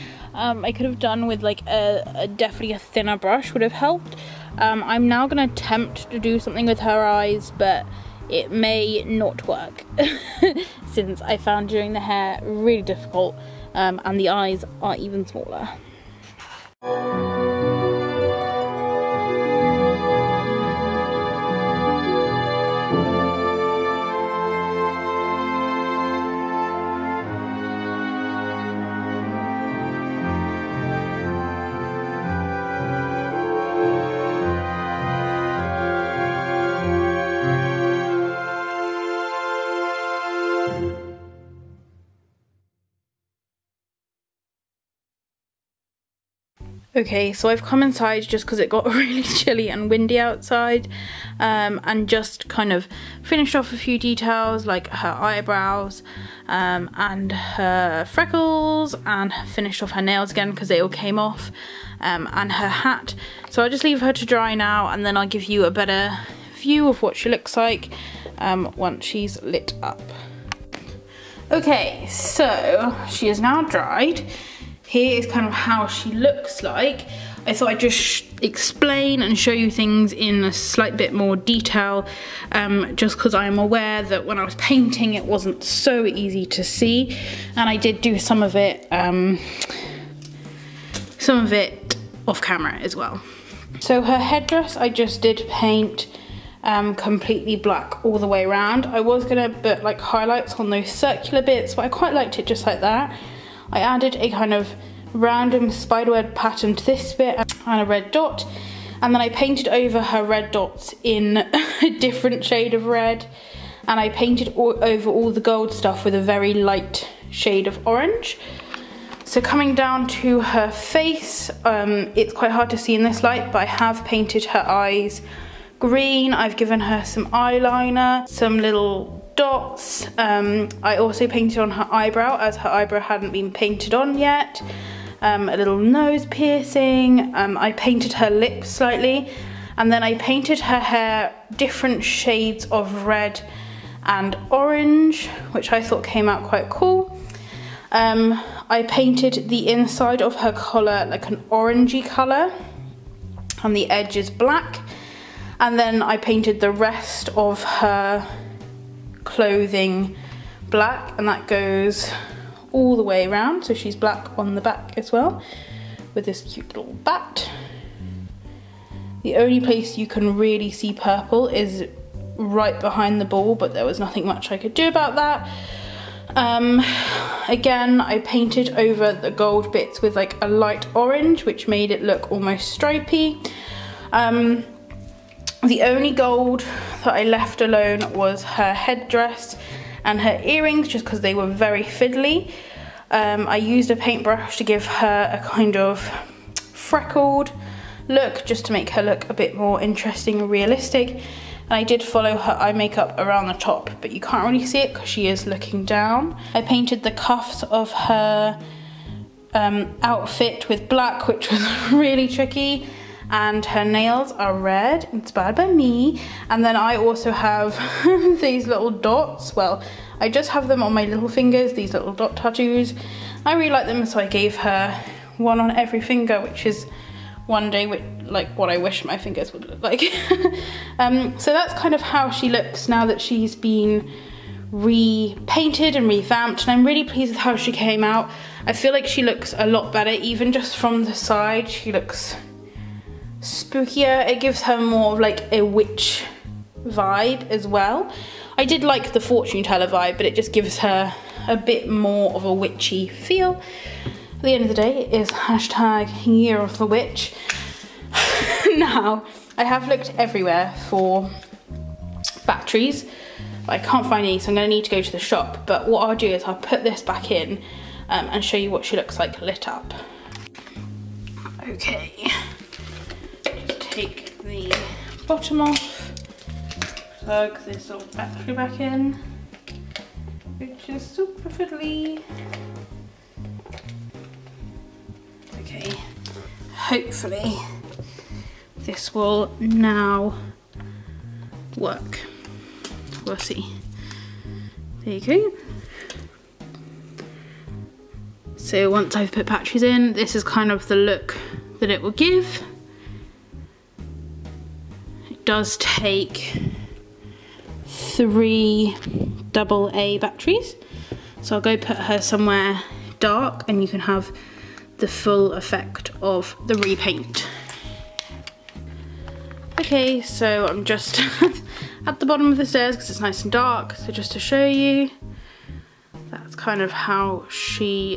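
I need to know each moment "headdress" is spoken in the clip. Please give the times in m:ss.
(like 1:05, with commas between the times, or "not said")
1:34, 3:08.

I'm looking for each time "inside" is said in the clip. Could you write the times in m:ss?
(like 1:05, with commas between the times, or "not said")
0:47, 2:29.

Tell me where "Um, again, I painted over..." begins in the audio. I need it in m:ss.
2:56.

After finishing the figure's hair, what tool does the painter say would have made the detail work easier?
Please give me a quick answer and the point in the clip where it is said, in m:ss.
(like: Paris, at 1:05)
A thinner brush, at 0:02.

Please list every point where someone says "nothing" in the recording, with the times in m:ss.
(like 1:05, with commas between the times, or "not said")
2:53.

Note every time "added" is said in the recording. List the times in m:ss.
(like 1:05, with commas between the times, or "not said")
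1:43.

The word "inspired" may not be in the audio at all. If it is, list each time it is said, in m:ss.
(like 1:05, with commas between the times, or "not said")
3:35.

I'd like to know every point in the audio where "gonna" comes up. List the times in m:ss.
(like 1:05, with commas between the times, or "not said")
0:05, 4:24.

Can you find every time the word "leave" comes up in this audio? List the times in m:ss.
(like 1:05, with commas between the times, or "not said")
1:03.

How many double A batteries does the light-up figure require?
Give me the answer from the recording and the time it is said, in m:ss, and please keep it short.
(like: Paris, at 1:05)
3, at 5:07.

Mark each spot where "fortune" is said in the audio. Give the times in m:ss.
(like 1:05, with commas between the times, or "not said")
4:09.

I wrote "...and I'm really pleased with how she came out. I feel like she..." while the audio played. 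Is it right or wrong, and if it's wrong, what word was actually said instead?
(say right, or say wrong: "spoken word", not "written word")
right.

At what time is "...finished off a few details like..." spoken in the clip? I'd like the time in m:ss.
0:53.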